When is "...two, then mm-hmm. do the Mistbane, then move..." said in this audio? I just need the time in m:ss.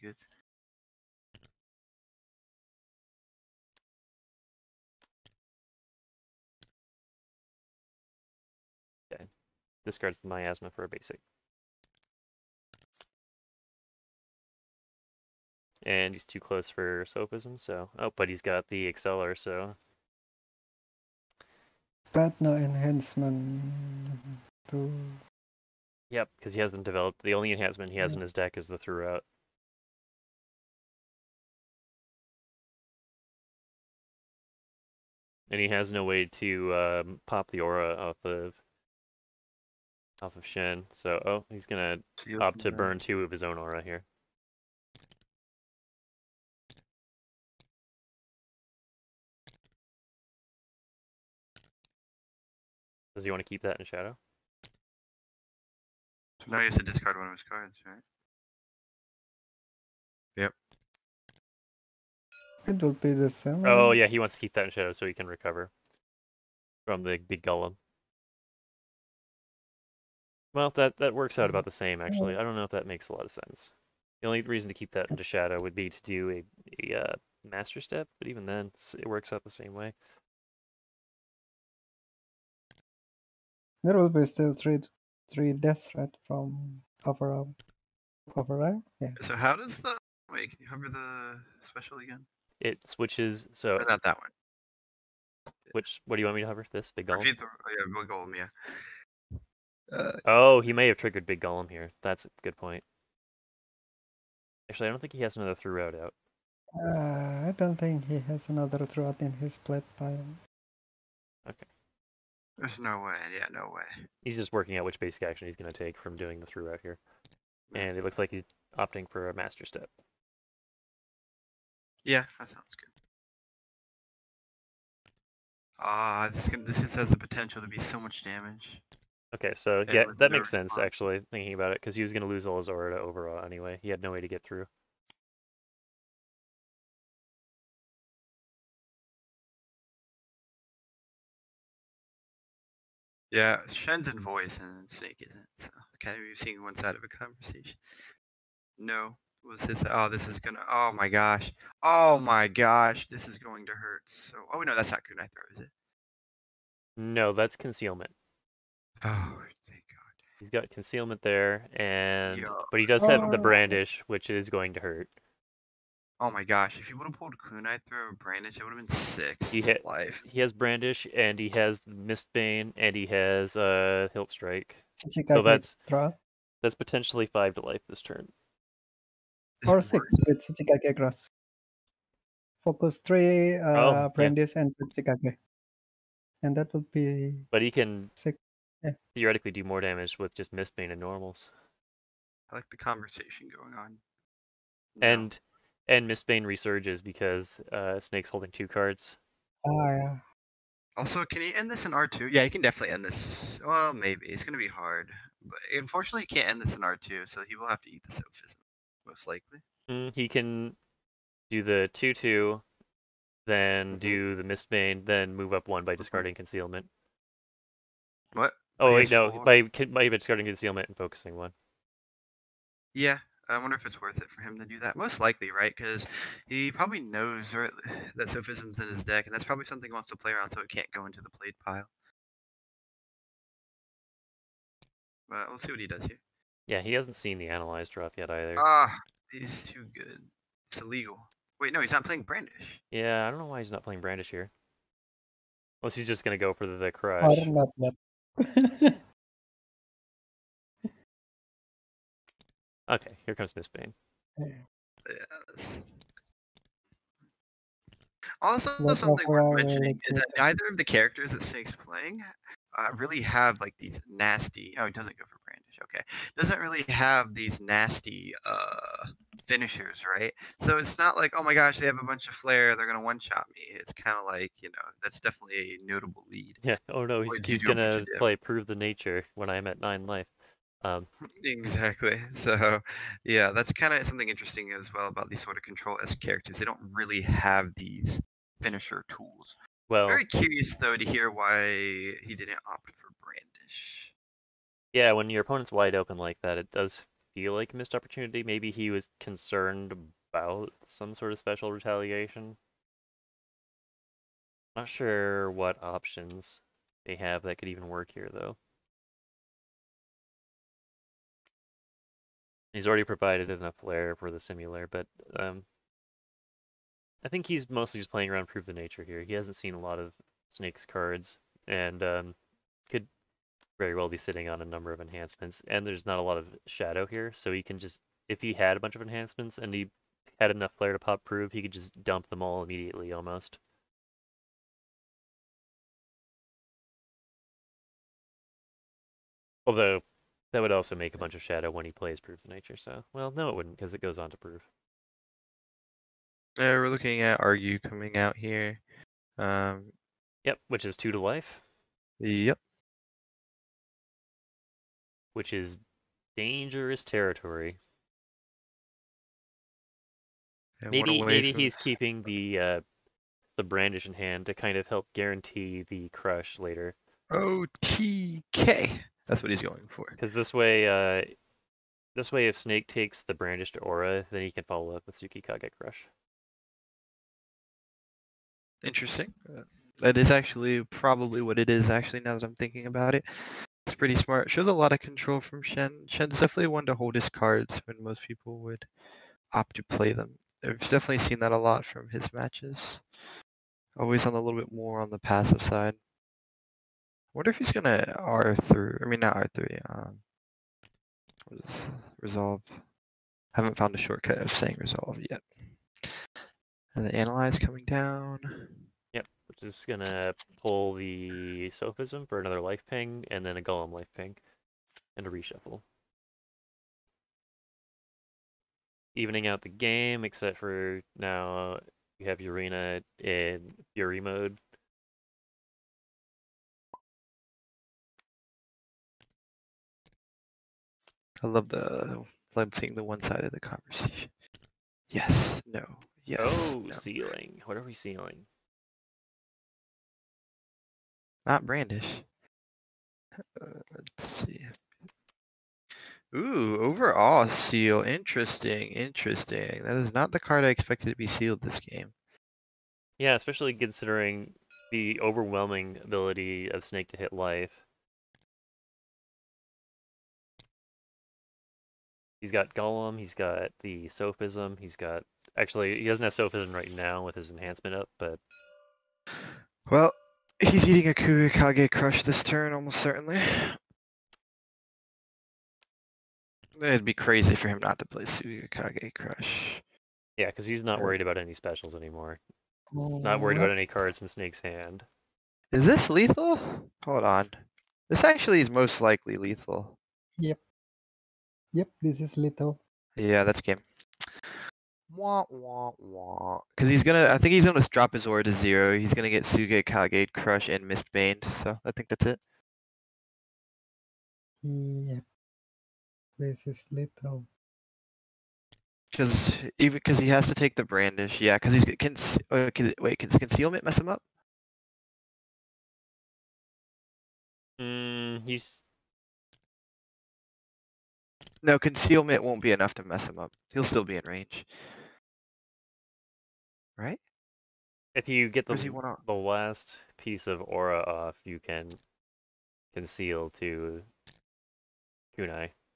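3:32.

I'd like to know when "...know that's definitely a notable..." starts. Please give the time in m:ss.
4:34.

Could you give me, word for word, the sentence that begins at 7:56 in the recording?
It'd be crazy for him not to play Surikage Crush.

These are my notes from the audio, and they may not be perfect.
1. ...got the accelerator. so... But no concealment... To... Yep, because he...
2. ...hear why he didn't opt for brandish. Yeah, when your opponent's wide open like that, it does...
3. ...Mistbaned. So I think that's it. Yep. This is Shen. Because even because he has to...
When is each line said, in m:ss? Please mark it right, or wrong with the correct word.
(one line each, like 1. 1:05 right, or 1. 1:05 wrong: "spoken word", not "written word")
1. 0:18 wrong: "enhancement", not "concealment"
2. 4:51 right
3. 8:20 wrong: "Little", not "Shen".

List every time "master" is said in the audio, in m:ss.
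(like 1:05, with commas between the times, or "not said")
1:17, 1:59.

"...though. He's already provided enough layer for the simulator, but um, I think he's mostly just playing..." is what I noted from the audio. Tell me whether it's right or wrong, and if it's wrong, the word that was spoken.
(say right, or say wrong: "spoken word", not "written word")
right.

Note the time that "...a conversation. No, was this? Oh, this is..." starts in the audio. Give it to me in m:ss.
2:27.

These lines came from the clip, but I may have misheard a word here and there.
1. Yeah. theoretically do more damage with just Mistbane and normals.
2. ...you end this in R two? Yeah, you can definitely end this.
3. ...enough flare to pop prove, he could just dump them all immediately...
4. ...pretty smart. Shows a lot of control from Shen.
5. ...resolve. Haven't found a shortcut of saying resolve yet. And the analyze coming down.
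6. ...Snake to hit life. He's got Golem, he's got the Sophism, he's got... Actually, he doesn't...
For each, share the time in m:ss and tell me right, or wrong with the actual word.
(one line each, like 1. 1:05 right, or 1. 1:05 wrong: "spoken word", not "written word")
1. 3:08 right
2. 3:21 right
3. 5:30 right
4. 6:23 right
5. 6:42 right
6. 7:36 right.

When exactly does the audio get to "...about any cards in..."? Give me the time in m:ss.
8:03.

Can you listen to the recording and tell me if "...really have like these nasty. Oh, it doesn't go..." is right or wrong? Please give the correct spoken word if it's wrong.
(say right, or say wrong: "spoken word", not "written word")
right.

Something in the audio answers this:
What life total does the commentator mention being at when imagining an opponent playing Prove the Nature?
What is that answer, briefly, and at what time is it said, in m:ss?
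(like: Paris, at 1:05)
9, at 4:39.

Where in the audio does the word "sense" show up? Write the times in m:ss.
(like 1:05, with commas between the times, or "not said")
1:13, 2:10.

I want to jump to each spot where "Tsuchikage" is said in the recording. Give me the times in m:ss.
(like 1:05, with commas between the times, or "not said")
3:00, 3:04.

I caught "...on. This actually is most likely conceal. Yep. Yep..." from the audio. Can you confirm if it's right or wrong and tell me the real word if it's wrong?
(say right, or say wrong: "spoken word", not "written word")
wrong: "lethal", not "conceal".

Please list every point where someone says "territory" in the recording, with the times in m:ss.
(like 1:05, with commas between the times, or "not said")
5:57.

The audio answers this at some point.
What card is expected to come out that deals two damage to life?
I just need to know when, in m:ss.
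5:47.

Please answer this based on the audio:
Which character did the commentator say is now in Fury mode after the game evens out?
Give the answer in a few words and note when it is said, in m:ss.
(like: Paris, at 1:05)
Yurina, at 7:02.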